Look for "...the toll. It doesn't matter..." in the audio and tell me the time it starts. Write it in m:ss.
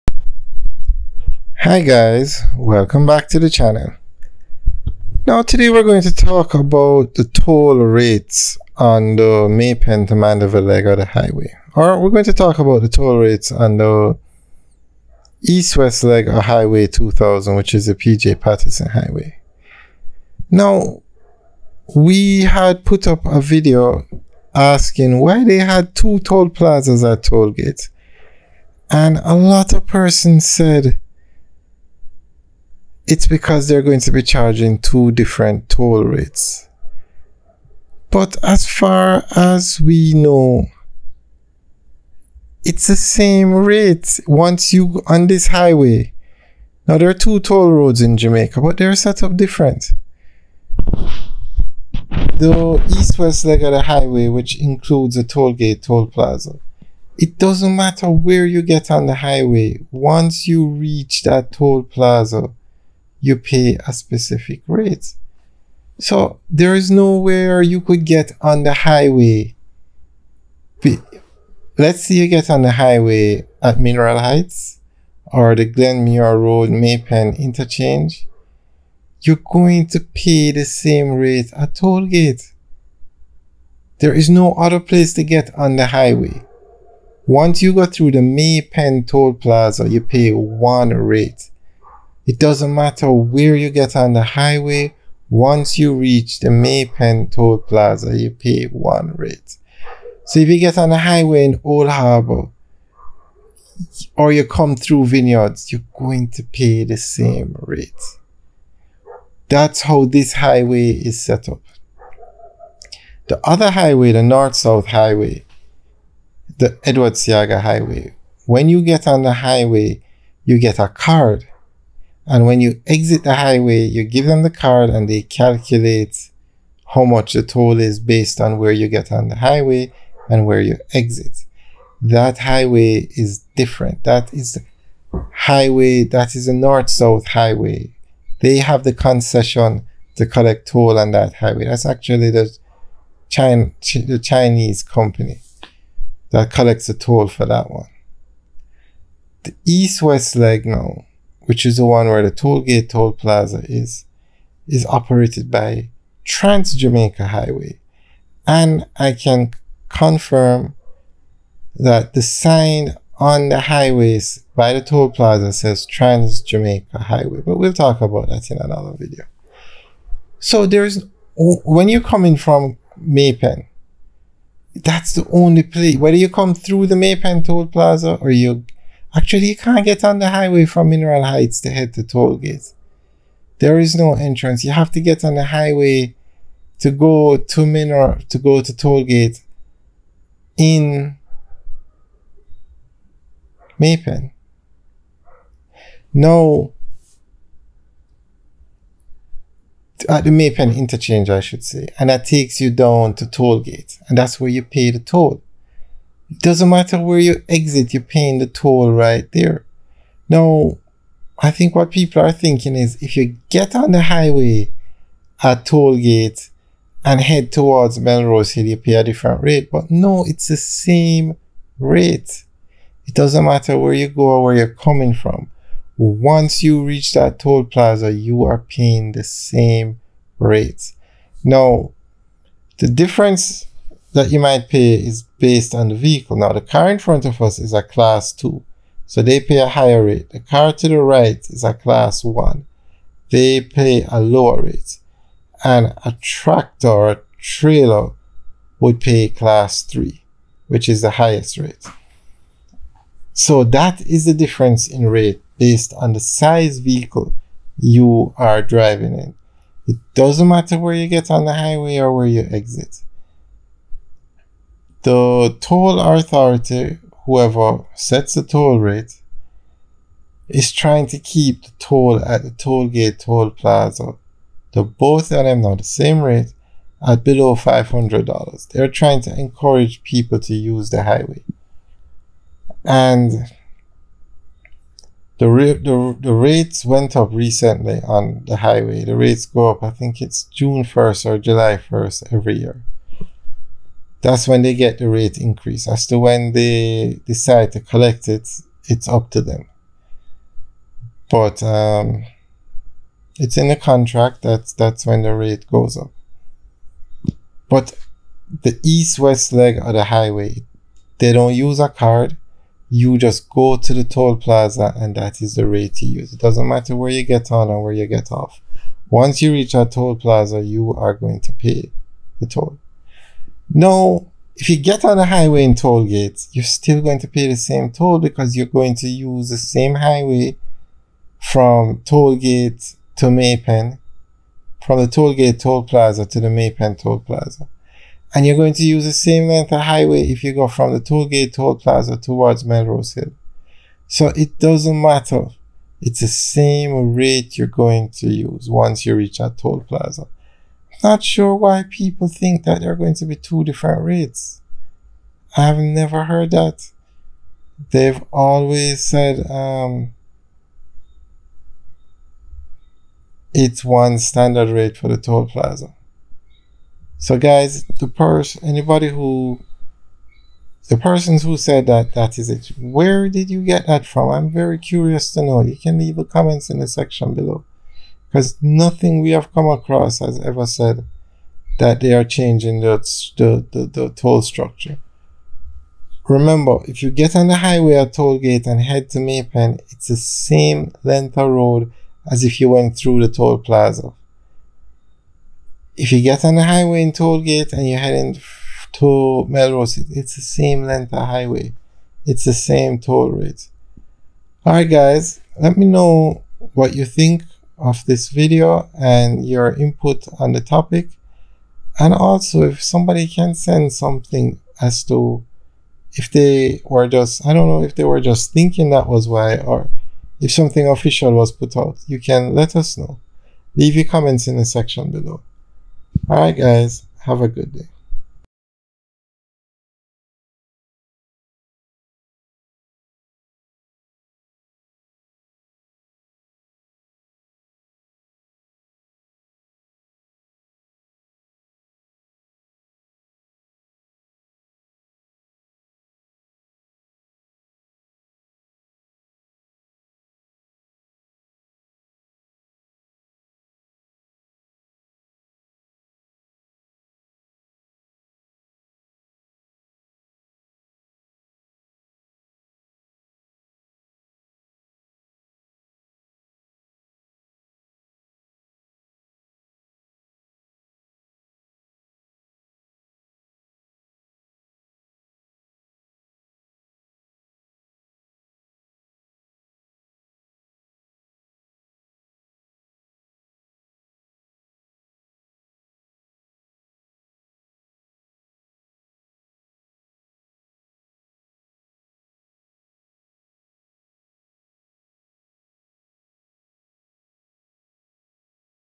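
3:24.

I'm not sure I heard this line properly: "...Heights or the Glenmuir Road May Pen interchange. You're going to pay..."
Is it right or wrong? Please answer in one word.
right.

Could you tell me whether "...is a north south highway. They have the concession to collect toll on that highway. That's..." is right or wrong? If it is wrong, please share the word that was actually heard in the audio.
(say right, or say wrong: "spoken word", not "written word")
right.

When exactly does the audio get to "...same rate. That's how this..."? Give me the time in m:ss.
1:46.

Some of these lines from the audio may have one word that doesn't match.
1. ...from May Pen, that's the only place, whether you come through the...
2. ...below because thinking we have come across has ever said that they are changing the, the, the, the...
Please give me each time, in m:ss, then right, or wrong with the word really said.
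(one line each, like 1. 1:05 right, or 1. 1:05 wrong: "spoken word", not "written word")
1. 2:52 right
2. 6:17 wrong: "nothing", not "thinking".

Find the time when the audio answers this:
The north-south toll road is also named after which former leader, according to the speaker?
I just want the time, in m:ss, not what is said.
1:56.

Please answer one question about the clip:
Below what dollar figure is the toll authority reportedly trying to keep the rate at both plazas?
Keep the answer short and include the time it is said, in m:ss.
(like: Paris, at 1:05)
$500, at 4:37.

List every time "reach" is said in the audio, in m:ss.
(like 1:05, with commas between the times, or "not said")
1:00, 1:35, 3:46, 5:19, 5:49.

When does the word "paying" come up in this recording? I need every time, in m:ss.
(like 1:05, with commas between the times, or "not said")
3:28, 3:48.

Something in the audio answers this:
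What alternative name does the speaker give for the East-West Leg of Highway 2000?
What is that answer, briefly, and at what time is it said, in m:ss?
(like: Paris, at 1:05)
PJ Patterson Highway, at 0:17.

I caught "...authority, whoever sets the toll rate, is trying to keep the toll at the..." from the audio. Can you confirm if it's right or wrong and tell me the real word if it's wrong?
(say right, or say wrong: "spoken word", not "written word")
right.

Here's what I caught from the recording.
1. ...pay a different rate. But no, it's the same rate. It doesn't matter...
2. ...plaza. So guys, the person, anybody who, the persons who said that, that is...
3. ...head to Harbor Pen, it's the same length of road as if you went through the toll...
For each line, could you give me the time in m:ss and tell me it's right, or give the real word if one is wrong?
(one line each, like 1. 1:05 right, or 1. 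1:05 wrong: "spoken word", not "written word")
1. 3:38 right
2. 6:05 right
3. 6:28 wrong: "May", not "Harbor".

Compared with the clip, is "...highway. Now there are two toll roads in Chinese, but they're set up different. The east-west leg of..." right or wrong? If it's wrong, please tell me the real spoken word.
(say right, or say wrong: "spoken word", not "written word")
wrong: "Jamaica", not "Chinese".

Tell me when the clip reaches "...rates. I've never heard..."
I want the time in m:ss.
5:54.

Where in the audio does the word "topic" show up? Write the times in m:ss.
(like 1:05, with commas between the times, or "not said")
6:50.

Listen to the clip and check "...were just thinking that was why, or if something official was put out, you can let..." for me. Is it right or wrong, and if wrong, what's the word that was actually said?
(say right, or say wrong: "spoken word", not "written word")
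right.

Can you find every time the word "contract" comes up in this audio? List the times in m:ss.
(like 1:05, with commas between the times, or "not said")
5:03.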